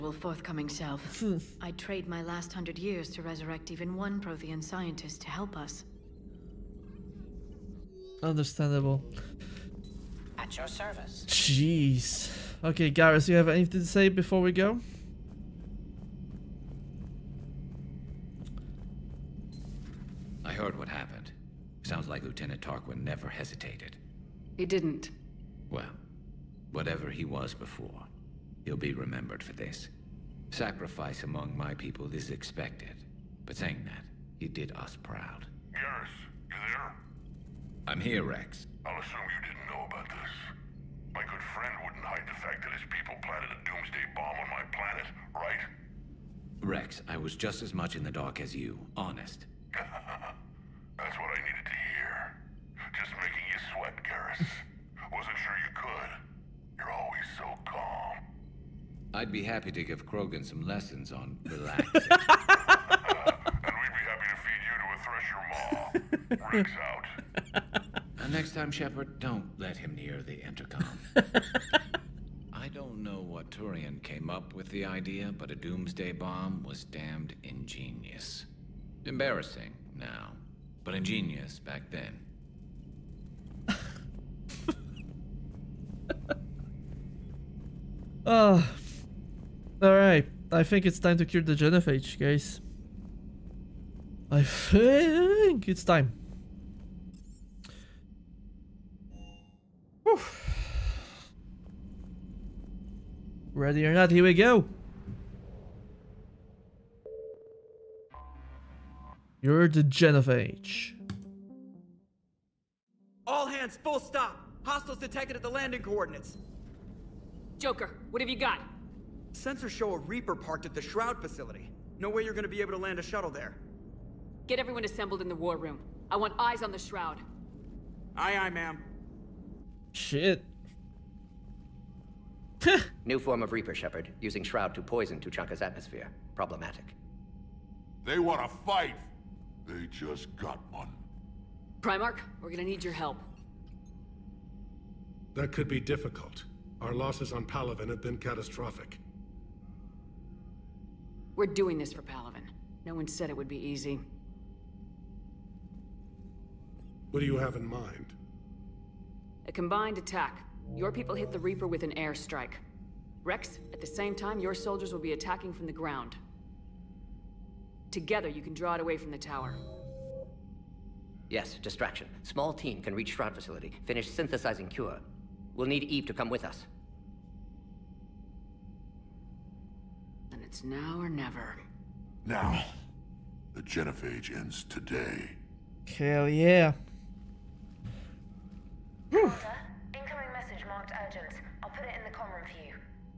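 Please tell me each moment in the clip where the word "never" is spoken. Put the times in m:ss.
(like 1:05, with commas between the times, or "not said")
0:23, 3:01.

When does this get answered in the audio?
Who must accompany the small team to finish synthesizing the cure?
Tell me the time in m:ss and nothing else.
2:55.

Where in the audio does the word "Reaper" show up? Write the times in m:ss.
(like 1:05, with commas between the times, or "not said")
1:59, 2:13, 2:41.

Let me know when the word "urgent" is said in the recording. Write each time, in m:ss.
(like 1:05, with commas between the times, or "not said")
3:11.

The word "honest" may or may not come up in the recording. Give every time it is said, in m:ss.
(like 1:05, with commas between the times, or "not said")
0:48.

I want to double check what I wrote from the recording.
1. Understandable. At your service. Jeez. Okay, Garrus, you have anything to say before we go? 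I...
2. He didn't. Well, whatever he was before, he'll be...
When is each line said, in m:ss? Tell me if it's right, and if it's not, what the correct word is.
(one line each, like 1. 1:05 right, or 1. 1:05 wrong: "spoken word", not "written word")
1. 0:08 right
2. 0:24 right.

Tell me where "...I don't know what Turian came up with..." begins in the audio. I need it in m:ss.
1:12.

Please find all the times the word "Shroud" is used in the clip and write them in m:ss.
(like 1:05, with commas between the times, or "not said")
2:00, 2:06, 2:14, 2:53.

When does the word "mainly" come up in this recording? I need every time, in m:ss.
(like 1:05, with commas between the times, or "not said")
not said.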